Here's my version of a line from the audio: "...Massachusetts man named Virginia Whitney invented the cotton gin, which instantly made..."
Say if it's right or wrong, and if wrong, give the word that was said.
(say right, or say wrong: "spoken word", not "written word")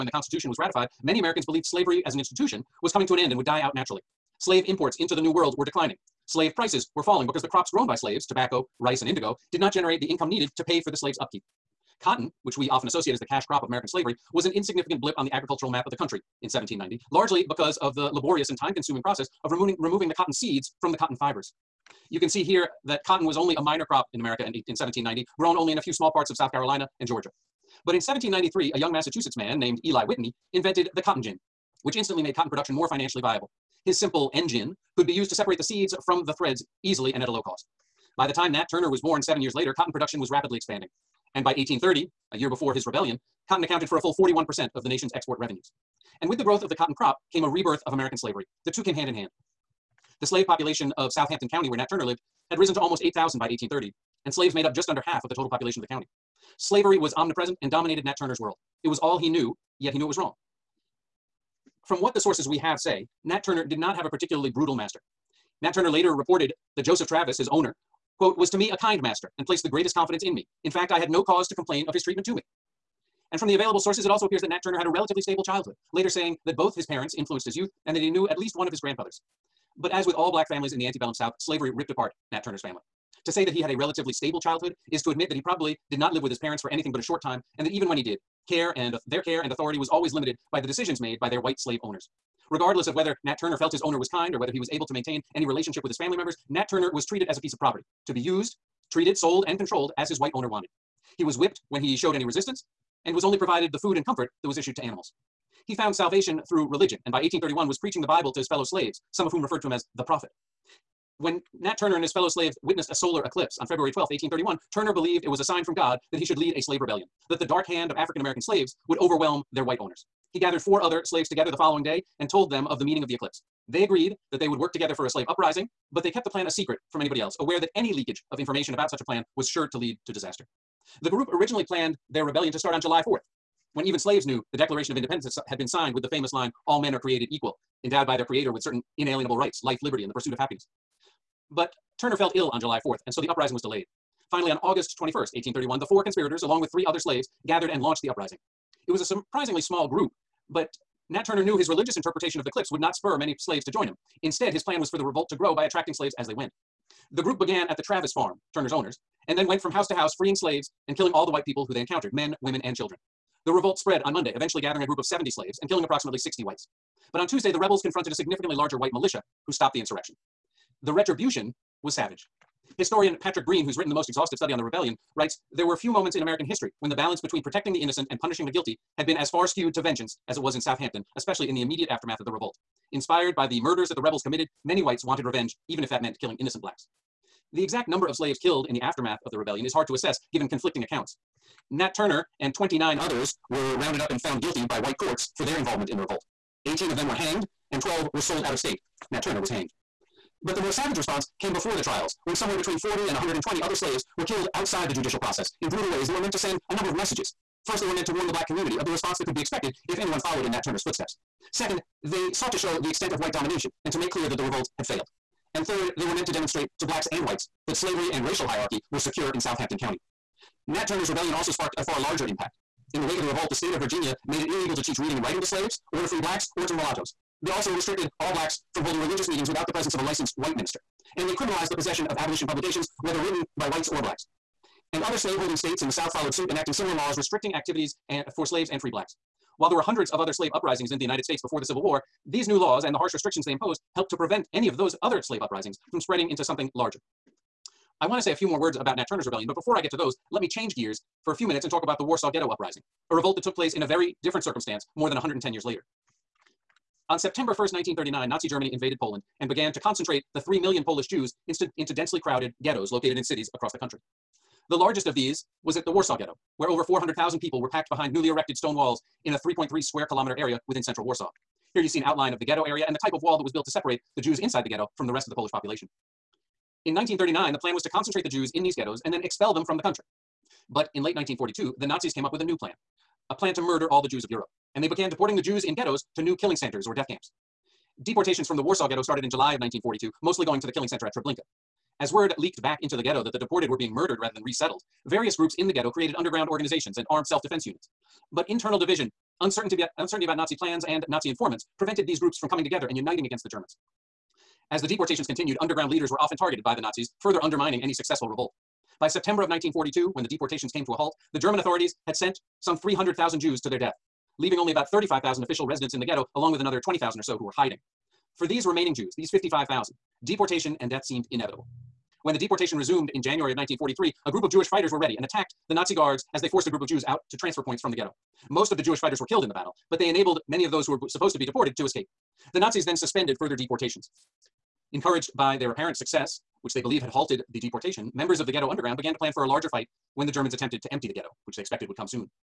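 wrong: "Eli", not "Virginia".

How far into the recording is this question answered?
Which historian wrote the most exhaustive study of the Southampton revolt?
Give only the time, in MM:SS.
02:53.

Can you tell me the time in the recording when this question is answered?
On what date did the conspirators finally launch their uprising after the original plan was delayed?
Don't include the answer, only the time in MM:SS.
02:24.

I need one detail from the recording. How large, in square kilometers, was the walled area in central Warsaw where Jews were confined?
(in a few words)
3.3.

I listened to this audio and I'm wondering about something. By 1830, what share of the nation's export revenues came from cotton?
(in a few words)
41%.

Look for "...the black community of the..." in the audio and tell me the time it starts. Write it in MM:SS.
03:28.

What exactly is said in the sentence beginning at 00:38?
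By the time Nat Turner was born seven years later, cotton production was rapidly expanding.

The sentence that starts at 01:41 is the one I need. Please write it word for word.
He was whipped when he showed any resistance and was only provided the food and comfort that was issued to animals.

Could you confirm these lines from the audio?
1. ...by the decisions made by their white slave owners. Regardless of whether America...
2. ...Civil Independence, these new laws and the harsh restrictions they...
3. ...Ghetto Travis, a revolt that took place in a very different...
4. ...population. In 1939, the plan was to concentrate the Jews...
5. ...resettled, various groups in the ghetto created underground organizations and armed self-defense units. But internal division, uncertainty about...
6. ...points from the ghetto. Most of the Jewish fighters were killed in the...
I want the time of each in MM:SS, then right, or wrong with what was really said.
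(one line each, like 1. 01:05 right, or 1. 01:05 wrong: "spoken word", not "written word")
1. 01:30 wrong: "Nat", not "America"
2. 04:01 wrong: "War", not "Independence"
3. 04:12 wrong: "Uprising", not "Travis"
4. 04:35 right
5. 04:54 right
6. 05:27 right.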